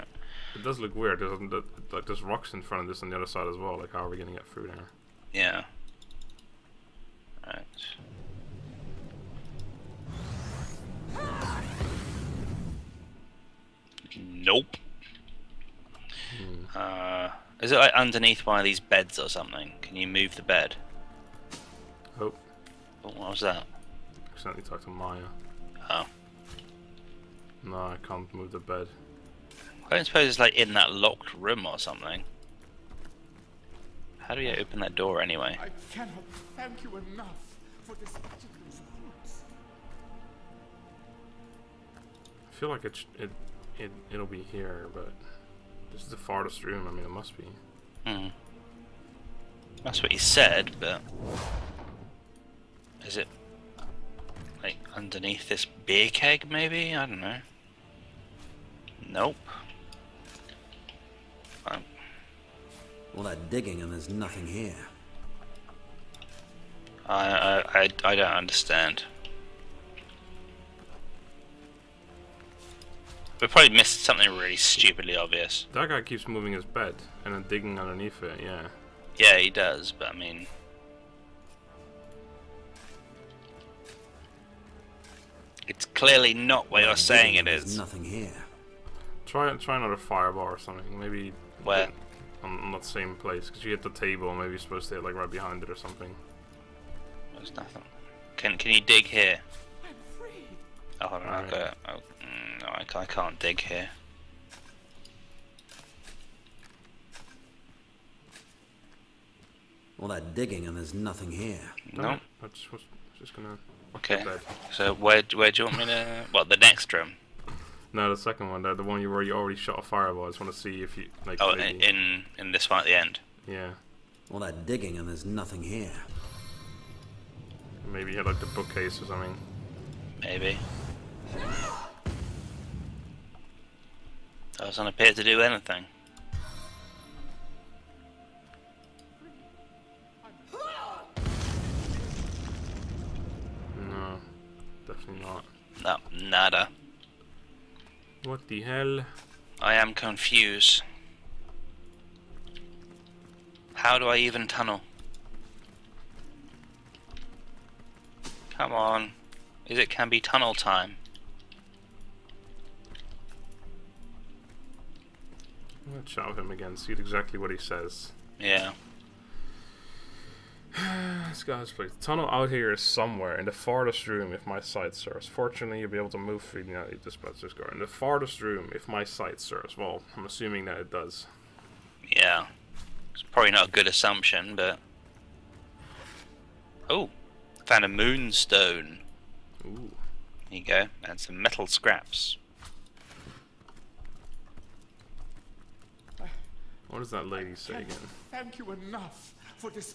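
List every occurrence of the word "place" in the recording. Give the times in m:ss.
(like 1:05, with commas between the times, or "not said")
1:33, 2:51.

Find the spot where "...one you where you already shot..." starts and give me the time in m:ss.
1:58.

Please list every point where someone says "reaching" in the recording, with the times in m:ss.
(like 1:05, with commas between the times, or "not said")
not said.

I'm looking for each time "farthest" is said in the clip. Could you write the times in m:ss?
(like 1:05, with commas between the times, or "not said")
0:46, 2:53, 2:57.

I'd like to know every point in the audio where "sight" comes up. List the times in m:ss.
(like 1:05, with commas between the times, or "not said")
2:54, 2:59.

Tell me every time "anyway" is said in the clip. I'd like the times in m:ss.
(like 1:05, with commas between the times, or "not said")
0:35.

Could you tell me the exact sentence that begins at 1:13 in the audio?
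We probably missed something really stupidly obvious.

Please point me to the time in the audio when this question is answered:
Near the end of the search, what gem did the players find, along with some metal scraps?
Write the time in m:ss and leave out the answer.
3:07.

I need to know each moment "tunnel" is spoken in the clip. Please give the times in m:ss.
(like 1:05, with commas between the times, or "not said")
2:34, 2:40, 2:52.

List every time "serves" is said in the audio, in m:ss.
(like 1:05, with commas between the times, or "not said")
2:54, 2:59.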